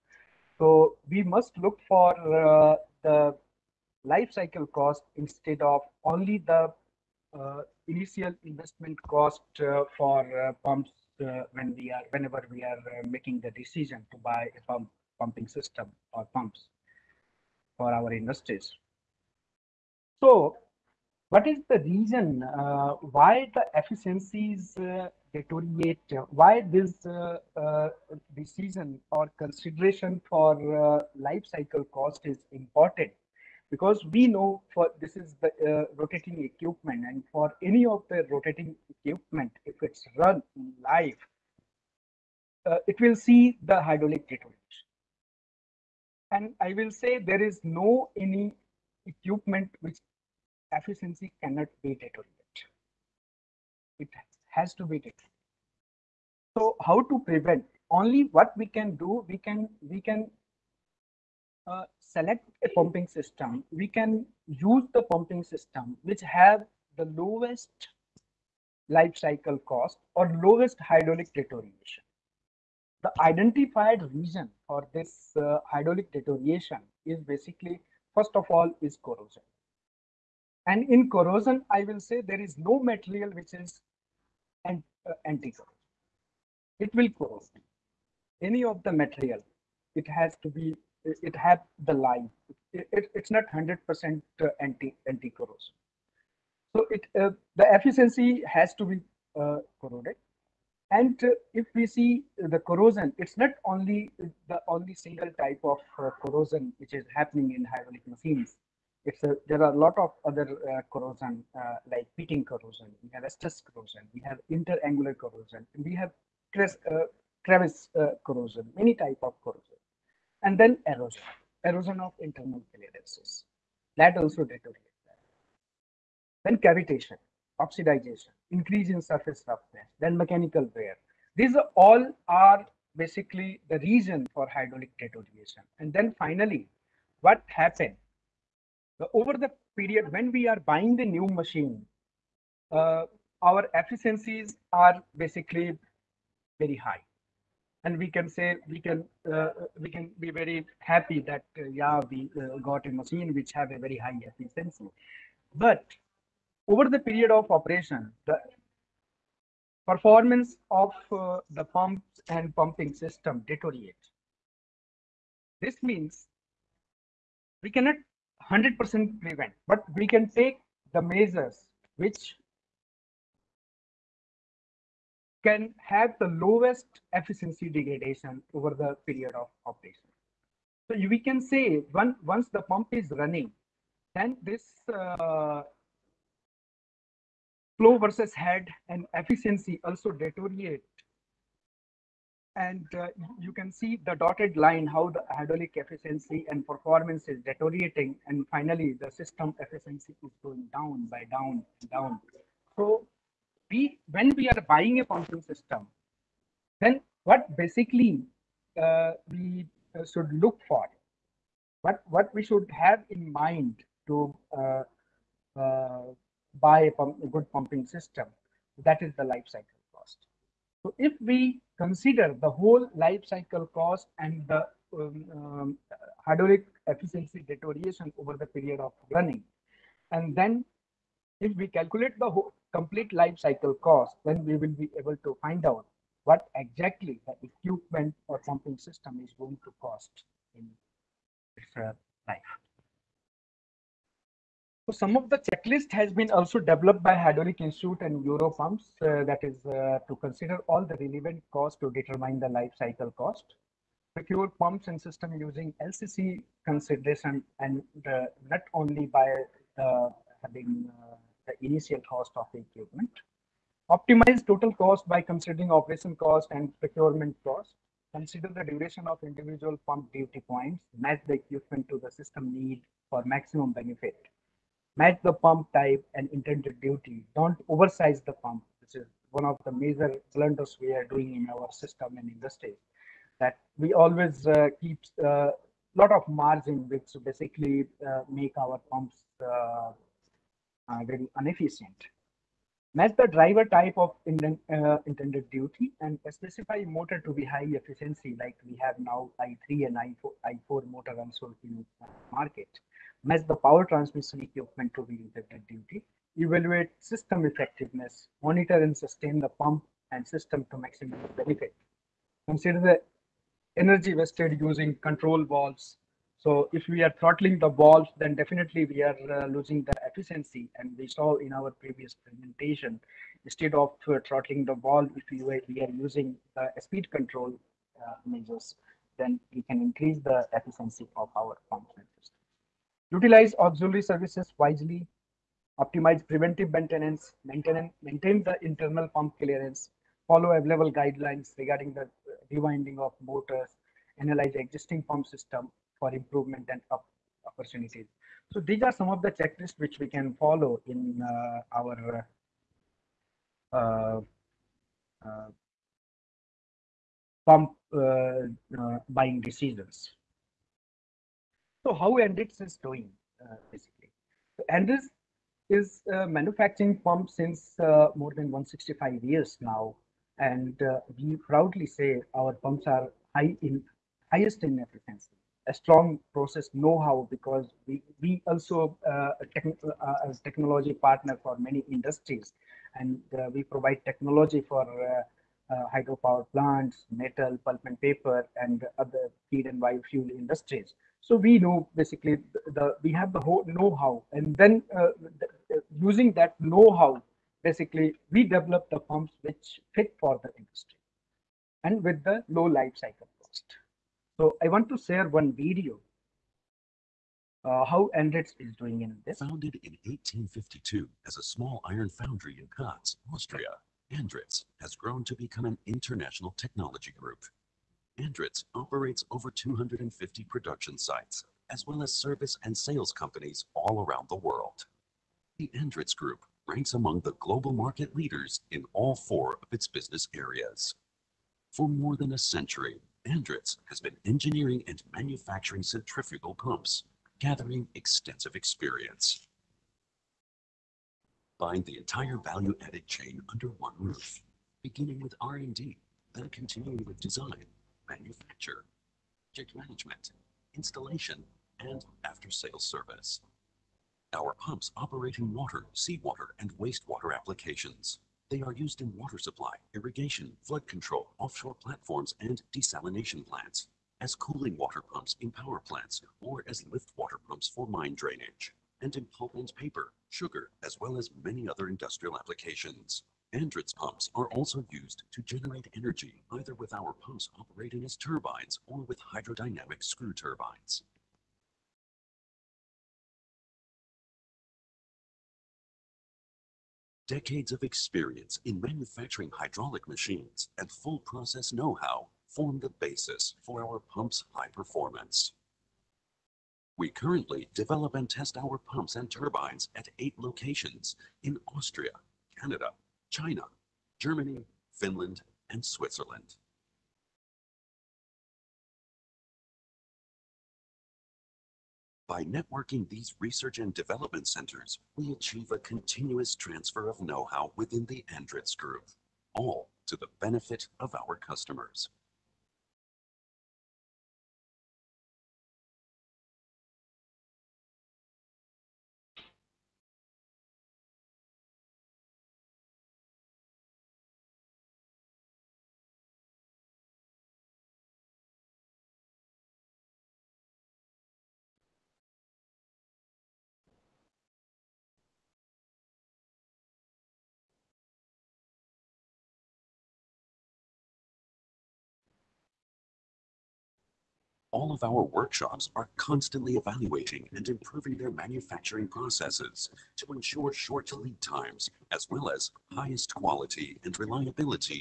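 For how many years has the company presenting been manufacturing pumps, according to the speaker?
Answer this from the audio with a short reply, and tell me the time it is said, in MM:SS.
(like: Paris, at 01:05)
More than 165 years, at 06:08.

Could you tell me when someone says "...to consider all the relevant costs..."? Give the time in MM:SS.
04:10.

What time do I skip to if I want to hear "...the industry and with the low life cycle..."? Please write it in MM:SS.
06:40.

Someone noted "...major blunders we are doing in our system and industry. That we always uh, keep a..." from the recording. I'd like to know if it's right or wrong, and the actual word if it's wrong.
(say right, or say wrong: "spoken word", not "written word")
right.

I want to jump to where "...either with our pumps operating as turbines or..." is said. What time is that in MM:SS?
07:56.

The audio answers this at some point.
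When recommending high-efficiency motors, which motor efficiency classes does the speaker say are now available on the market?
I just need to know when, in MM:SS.
04:59.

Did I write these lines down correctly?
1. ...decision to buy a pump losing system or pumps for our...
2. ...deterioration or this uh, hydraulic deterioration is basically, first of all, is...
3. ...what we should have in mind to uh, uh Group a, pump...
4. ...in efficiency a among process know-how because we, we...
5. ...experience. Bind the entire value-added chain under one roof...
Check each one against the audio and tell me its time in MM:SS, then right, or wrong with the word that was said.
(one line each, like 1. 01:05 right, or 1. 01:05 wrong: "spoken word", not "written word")
1. 00:13 wrong: "pumping", not "losing"
2. 01:14 wrong: "region", not "deterioration"
3. 03:32 wrong: "Buy", not "Group"
4. 06:14 wrong: "strong", not "among"
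5. 07:18 right.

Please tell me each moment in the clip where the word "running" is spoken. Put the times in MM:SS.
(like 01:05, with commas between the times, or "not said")
03:03, 03:49.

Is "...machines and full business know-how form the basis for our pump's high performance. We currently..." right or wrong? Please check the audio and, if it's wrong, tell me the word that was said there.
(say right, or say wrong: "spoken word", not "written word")
wrong: "process", not "business".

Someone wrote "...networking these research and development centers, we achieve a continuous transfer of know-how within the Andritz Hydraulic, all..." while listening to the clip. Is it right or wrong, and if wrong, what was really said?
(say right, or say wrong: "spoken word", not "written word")
wrong: "Group", not "Hydraulic".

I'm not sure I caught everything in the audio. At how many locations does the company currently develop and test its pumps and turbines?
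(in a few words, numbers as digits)
8.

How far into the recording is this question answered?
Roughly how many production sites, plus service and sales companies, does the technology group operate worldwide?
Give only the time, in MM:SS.
06:59.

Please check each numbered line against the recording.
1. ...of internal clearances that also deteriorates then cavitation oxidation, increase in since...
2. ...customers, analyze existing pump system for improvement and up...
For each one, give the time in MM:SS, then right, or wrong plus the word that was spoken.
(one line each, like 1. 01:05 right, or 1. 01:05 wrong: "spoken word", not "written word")
1. 02:02 wrong: "surface", not "since"
2. 05:43 wrong: "motors", not "customers".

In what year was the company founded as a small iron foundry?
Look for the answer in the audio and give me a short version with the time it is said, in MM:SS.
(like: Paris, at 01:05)
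1852, at 06:50.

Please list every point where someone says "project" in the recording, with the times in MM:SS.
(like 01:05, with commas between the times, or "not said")
07:29.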